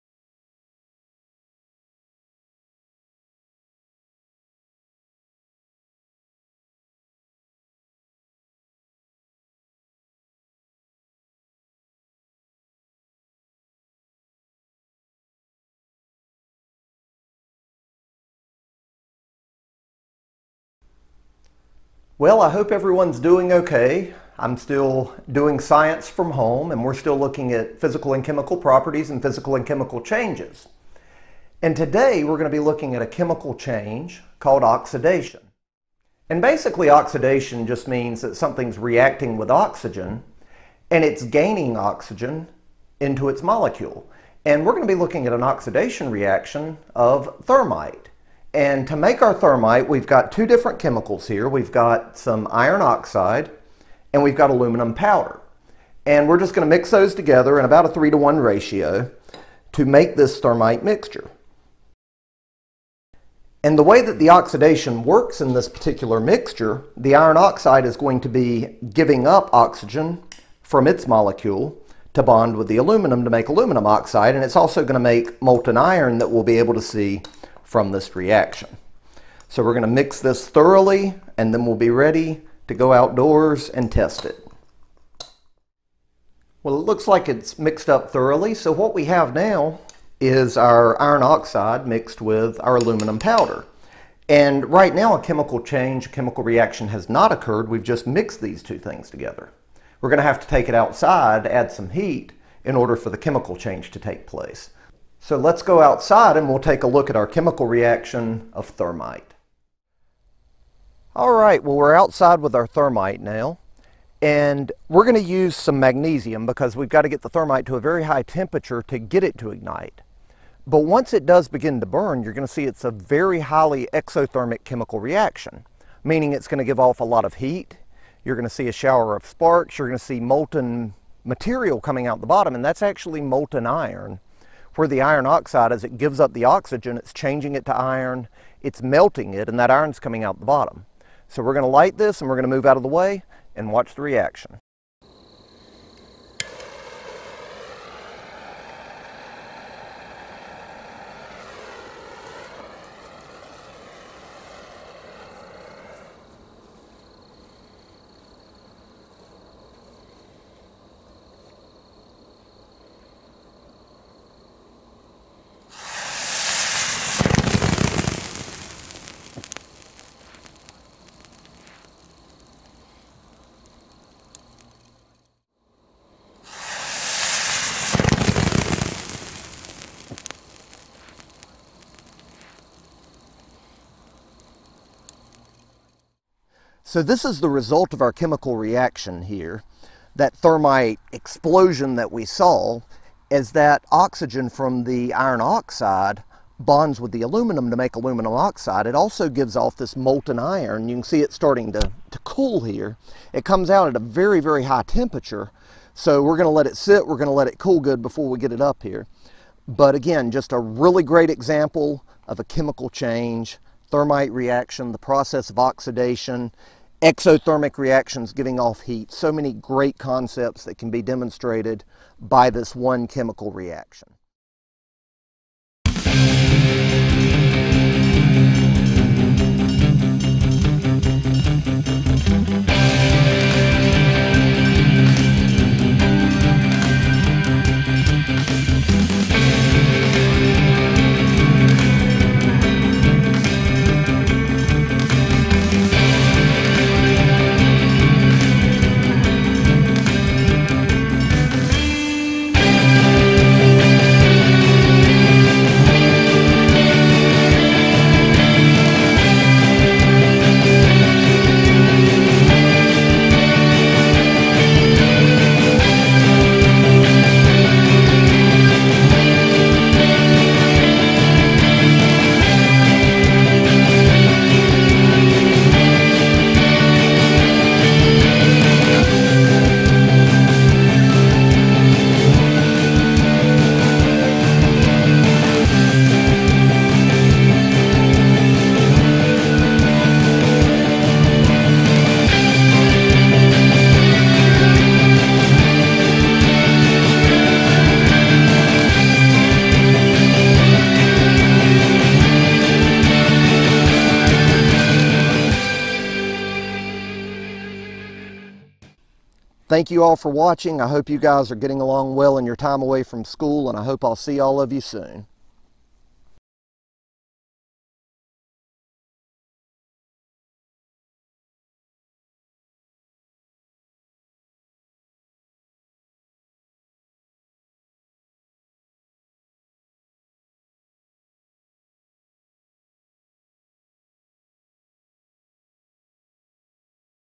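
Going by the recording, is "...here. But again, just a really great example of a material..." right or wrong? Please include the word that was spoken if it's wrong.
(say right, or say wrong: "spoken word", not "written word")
wrong: "chemical", not "material".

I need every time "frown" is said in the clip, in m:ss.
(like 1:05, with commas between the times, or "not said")
not said.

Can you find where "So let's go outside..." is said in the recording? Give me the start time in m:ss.
1:45.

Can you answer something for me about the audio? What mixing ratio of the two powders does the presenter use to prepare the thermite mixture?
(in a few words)
3 to 1.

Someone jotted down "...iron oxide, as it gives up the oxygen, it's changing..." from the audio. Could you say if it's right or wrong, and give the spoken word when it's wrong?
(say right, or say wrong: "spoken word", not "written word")
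right.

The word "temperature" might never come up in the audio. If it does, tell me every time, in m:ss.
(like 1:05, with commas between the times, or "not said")
1:58, 3:24.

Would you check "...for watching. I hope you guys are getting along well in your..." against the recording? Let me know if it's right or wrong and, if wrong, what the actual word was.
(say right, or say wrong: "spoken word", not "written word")
right.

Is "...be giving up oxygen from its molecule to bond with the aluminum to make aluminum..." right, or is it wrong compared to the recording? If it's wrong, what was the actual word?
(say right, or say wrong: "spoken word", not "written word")
right.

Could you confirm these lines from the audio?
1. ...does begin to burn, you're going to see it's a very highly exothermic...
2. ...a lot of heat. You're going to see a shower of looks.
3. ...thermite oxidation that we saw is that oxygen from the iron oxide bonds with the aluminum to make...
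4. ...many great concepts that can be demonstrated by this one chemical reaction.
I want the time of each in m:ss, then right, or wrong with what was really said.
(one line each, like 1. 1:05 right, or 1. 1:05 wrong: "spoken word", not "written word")
1. 2:01 right
2. 2:06 wrong: "sparks", not "looks"
3. 3:10 wrong: "explosion", not "oxidation"
4. 3:39 right.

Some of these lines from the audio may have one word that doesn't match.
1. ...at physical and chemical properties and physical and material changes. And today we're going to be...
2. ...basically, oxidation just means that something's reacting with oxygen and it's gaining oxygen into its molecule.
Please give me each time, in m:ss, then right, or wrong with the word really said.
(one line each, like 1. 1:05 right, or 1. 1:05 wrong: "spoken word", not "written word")
1. 0:27 wrong: "chemical", not "material"
2. 0:36 right.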